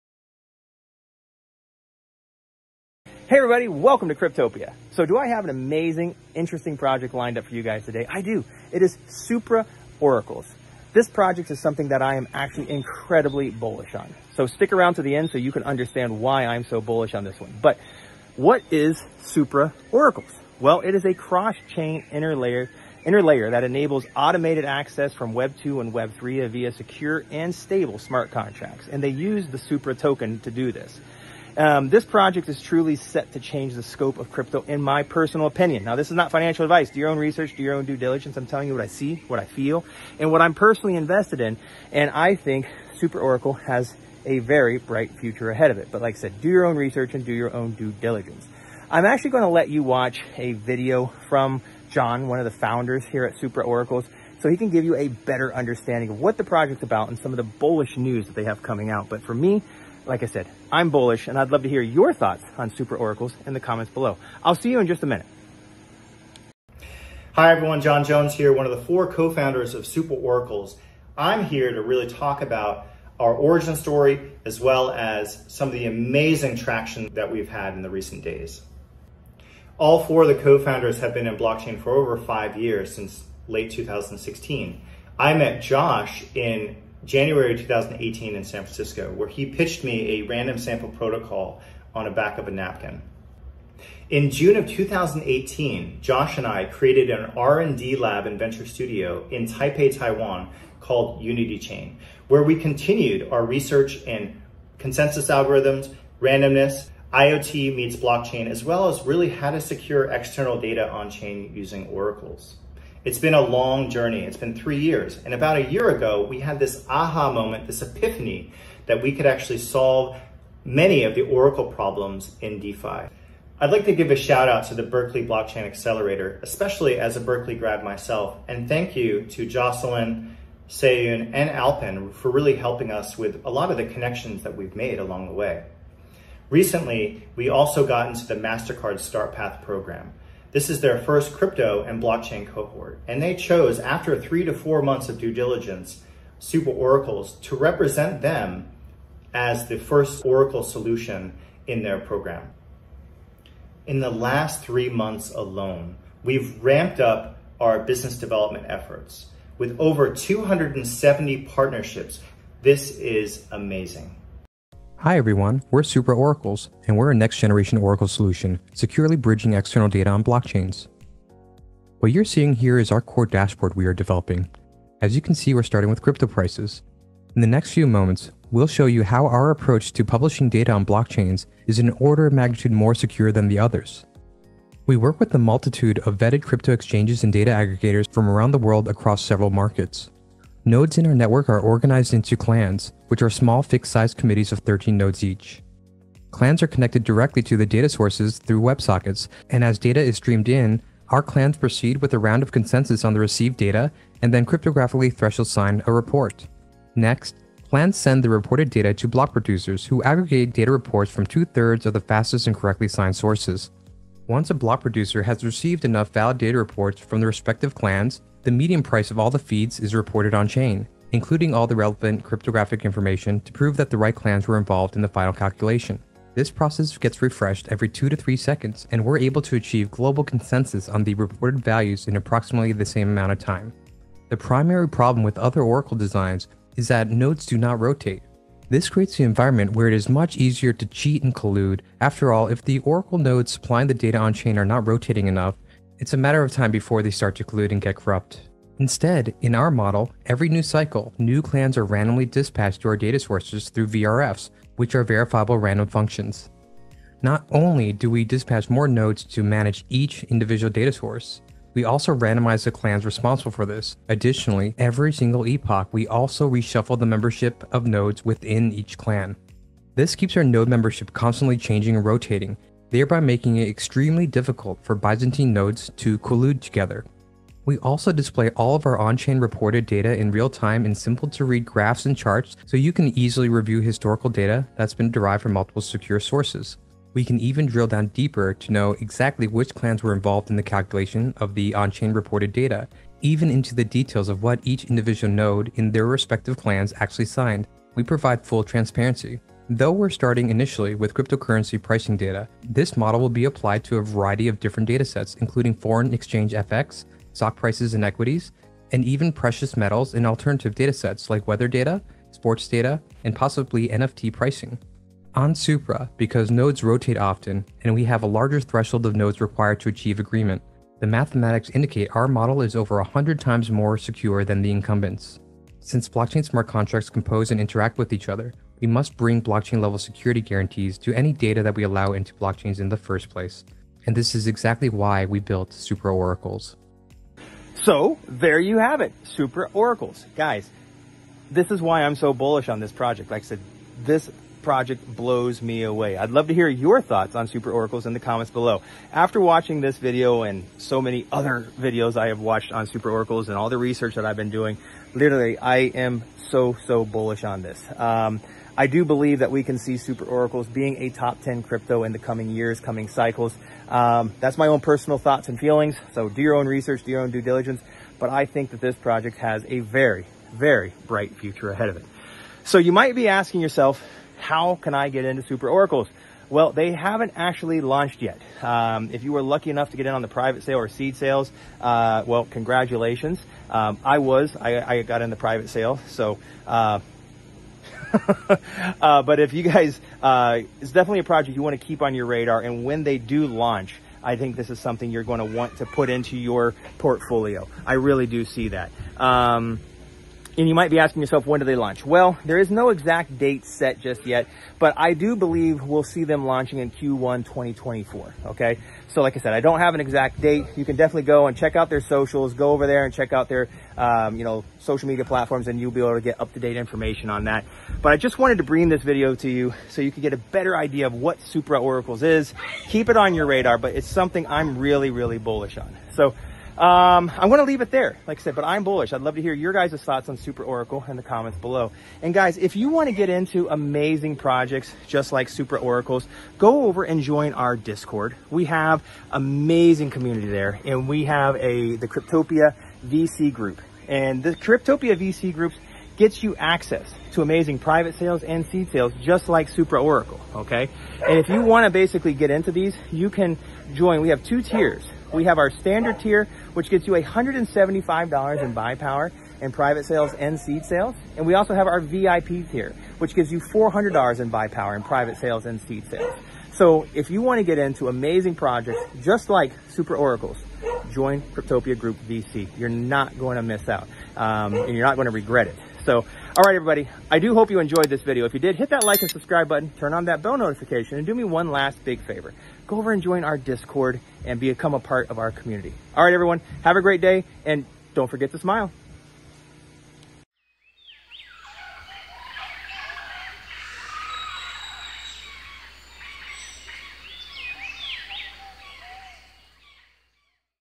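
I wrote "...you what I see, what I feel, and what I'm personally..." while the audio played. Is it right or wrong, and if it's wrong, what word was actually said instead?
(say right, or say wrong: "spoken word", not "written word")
right.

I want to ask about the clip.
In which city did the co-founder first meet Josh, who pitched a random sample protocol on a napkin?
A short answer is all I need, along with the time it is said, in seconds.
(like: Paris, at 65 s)
San Francisco, at 88 s.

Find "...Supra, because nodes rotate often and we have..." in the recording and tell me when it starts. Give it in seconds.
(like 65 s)
315 s.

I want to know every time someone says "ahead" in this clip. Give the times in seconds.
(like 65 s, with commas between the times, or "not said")
45 s, 371 s.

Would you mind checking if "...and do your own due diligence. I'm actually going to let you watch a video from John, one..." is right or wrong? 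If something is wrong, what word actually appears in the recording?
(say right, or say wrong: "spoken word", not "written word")
right.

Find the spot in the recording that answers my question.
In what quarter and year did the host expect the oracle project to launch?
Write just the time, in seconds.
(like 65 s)
406 s.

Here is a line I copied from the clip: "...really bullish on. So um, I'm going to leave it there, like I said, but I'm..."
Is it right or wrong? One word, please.
right.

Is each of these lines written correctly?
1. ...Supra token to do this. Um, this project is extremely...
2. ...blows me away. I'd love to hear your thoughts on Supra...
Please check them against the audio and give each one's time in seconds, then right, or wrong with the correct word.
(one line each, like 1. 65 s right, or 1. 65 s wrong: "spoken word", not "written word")
1. 29 s wrong: "truly", not "extremely"
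2. 345 s right.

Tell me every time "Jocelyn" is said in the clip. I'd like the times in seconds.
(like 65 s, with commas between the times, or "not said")
129 s.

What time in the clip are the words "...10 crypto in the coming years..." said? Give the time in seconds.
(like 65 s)
361 s.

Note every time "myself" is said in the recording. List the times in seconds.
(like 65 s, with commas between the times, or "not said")
127 s.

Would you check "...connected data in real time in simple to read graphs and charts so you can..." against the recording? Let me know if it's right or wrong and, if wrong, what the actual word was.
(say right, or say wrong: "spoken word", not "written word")
wrong: "reported", not "connected".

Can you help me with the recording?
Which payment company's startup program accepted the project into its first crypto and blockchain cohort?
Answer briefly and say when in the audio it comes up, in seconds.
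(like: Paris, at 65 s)
MasterCard, at 138 s.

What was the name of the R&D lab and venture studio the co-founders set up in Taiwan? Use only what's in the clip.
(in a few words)
Unity Chain.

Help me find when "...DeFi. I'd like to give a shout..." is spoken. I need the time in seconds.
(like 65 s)
122 s.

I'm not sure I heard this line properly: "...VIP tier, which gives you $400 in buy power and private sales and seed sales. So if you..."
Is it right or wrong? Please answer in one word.
right.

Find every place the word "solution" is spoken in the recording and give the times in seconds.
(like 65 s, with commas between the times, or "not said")
150 s, 168 s.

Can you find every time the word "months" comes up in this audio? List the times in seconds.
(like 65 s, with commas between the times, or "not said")
144 s, 154 s.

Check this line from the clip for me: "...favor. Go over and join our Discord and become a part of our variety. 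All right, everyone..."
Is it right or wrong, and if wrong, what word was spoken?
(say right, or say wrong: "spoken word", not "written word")
wrong: "community", not "variety".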